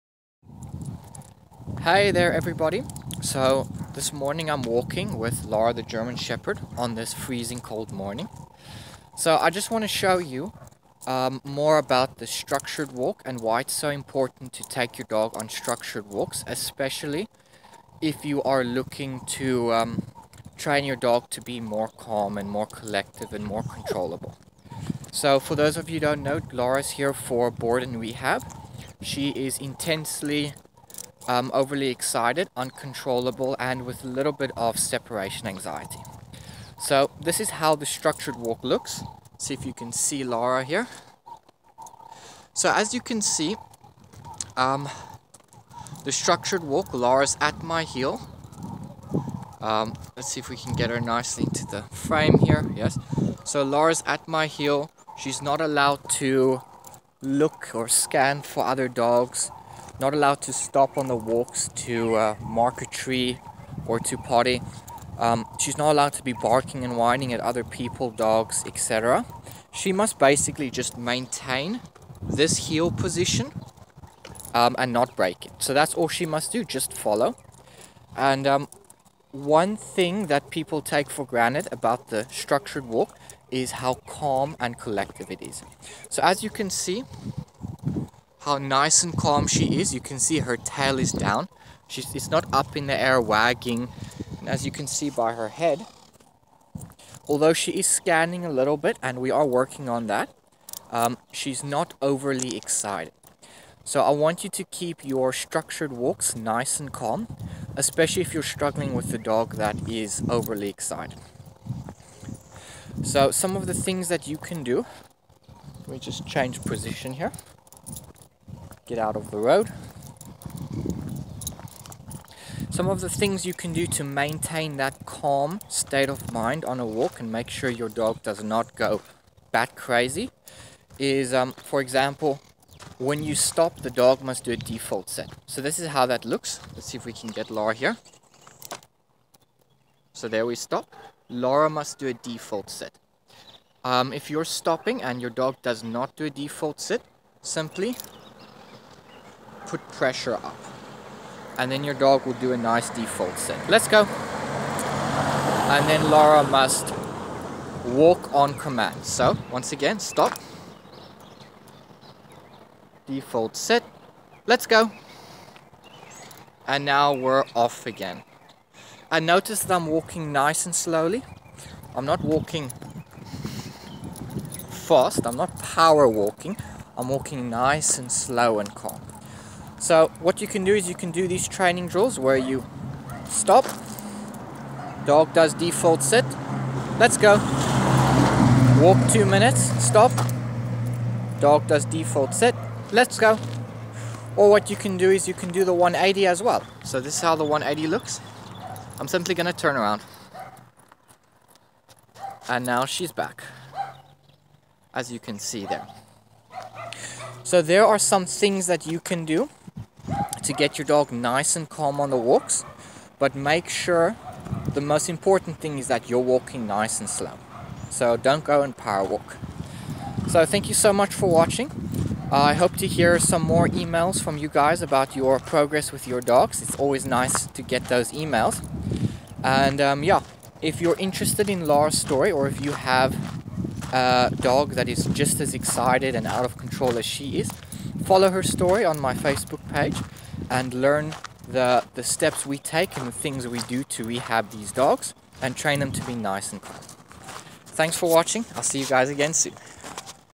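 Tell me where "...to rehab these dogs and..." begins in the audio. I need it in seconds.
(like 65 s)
243 s.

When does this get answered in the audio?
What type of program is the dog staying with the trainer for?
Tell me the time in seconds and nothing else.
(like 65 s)
27 s.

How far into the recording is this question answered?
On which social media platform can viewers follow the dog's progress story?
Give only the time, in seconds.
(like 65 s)
239 s.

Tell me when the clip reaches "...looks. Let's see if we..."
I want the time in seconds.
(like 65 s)
136 s.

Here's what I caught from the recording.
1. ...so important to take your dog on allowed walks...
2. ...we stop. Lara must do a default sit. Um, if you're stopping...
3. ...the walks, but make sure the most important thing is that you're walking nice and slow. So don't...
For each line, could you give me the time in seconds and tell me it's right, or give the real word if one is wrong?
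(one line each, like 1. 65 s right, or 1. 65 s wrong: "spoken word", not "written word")
1. 13 s wrong: "structured", not "allowed"
2. 140 s right
3. 212 s right.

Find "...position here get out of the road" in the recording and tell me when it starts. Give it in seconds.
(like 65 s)
116 s.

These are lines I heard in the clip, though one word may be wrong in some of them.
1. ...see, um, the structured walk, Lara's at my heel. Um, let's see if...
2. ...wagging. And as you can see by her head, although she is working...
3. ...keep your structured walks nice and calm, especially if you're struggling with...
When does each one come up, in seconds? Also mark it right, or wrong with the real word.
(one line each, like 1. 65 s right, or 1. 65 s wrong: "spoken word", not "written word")
1. 43 s right
2. 93 s wrong: "scanning", not "working"
3. 104 s right.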